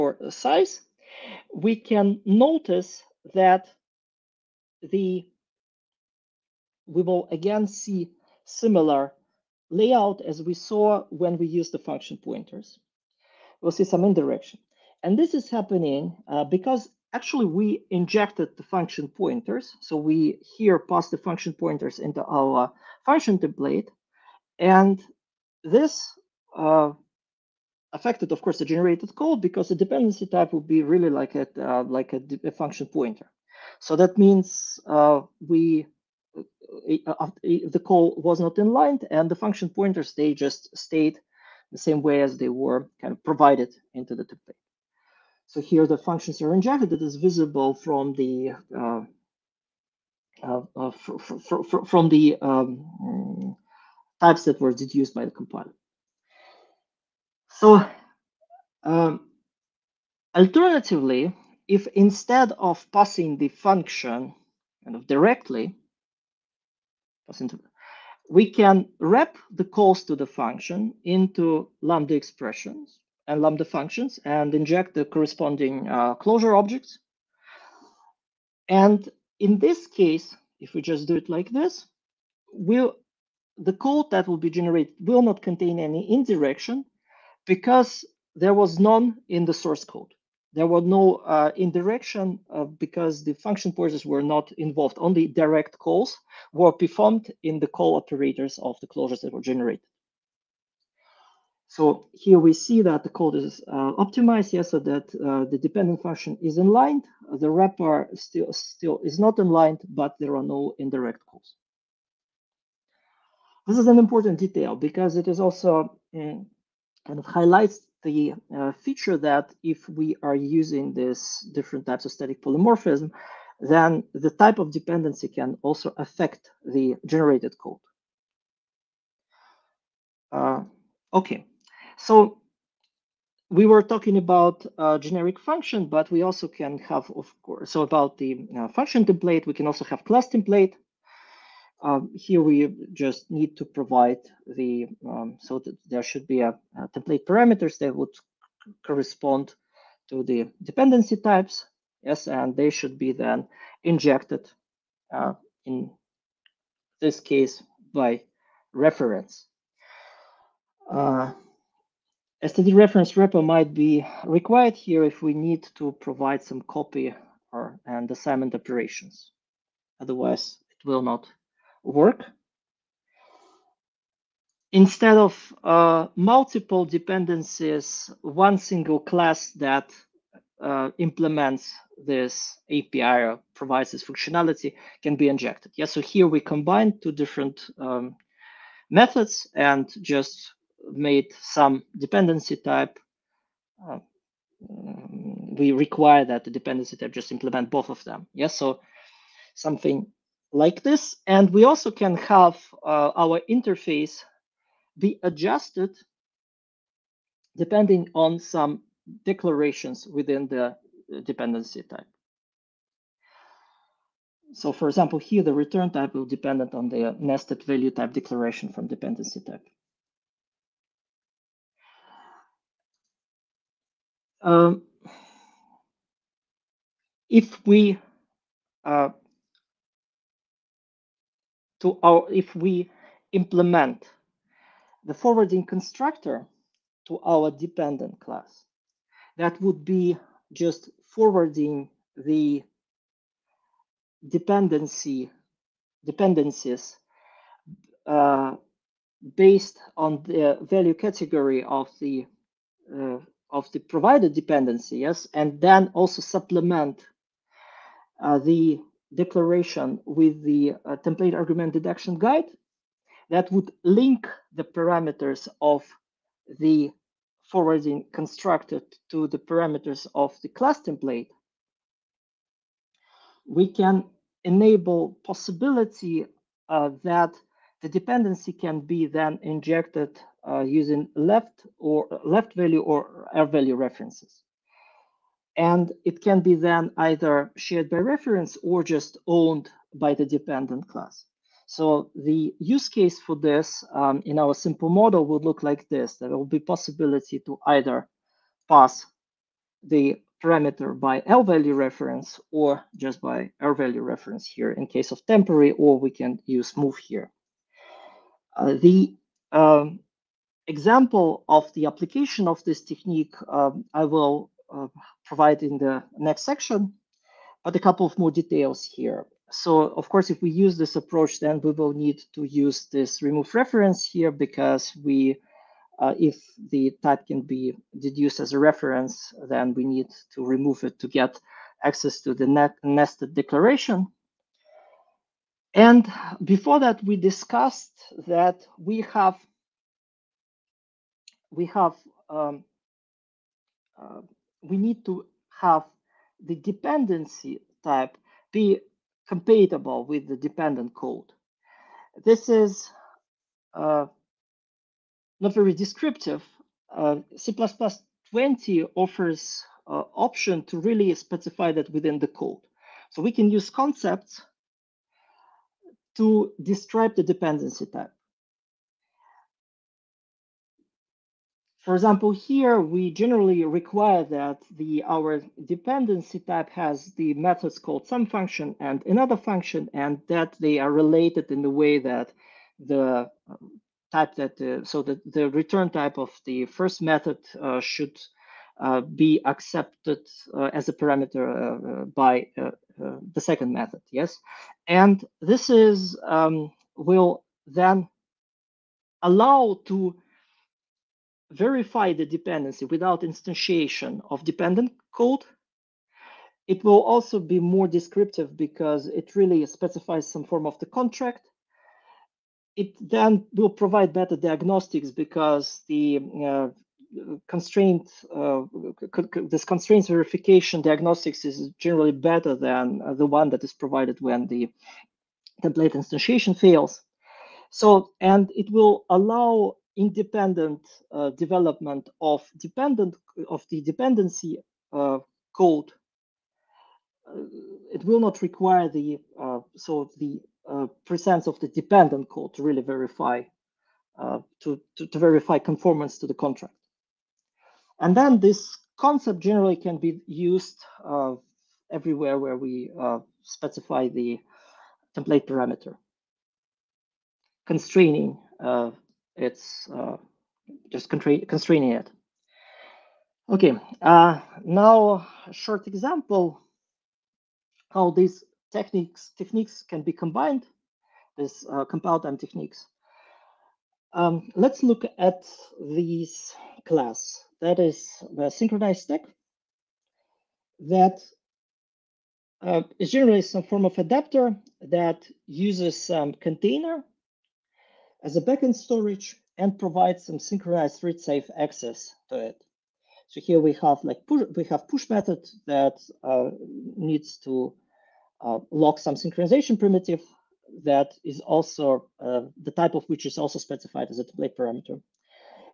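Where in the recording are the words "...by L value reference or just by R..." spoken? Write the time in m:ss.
5:00.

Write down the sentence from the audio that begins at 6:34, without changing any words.
Yes, and this is um, will then allow to verify the dependency without instantiation of dependent code.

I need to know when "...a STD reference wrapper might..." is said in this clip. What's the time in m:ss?
2:42.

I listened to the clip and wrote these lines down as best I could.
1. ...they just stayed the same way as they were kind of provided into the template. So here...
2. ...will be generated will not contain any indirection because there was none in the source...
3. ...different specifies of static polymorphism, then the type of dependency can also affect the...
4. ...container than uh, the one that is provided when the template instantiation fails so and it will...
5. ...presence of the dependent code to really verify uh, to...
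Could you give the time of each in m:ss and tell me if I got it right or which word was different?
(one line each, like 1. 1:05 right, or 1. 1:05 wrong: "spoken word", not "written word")
1. 0:40 right
2. 1:24 right
3. 2:01 wrong: "types", not "specifies"
4. 7:02 wrong: "better", not "container"
5. 7:21 right.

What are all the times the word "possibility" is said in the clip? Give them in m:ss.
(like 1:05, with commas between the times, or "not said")
4:35, 4:56.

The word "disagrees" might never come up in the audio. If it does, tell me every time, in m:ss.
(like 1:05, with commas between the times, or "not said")
not said.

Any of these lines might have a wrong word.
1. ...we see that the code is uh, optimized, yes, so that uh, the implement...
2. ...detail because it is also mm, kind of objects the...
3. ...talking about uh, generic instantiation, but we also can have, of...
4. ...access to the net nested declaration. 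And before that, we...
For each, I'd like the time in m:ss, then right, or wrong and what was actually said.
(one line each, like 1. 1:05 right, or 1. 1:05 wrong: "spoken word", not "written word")
1. 1:42 wrong: "dependent", not "implement"
2. 1:54 wrong: "highlights", not "objects"
3. 2:13 wrong: "function", not "instantiation"
4. 5:31 right.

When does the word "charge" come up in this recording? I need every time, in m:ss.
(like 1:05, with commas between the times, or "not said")
not said.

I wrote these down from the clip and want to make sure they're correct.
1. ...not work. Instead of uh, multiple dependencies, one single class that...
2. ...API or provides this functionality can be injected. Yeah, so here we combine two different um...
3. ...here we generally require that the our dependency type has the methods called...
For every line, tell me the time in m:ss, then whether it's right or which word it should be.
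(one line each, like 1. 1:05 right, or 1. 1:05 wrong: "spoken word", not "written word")
1. 2:51 right
2. 3:02 right
3. 6:12 right.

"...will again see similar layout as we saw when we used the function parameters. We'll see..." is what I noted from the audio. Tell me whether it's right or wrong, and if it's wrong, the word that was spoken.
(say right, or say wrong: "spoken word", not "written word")
wrong: "pointers", not "parameters".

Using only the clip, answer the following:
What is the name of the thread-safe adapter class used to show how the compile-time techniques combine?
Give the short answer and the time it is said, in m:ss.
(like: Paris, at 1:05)
synchronized stack, at 7:58.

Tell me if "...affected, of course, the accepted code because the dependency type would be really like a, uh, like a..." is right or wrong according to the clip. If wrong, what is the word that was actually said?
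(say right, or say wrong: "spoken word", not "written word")
wrong: "generated", not "accepted".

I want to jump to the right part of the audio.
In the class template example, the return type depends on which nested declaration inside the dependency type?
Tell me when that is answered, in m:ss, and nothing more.
3:37.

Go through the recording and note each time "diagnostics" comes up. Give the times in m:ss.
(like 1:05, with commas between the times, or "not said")
6:54, 7:00.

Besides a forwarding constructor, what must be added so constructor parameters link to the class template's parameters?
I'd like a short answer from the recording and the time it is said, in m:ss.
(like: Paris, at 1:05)
template argument deduction guide, at 4:20.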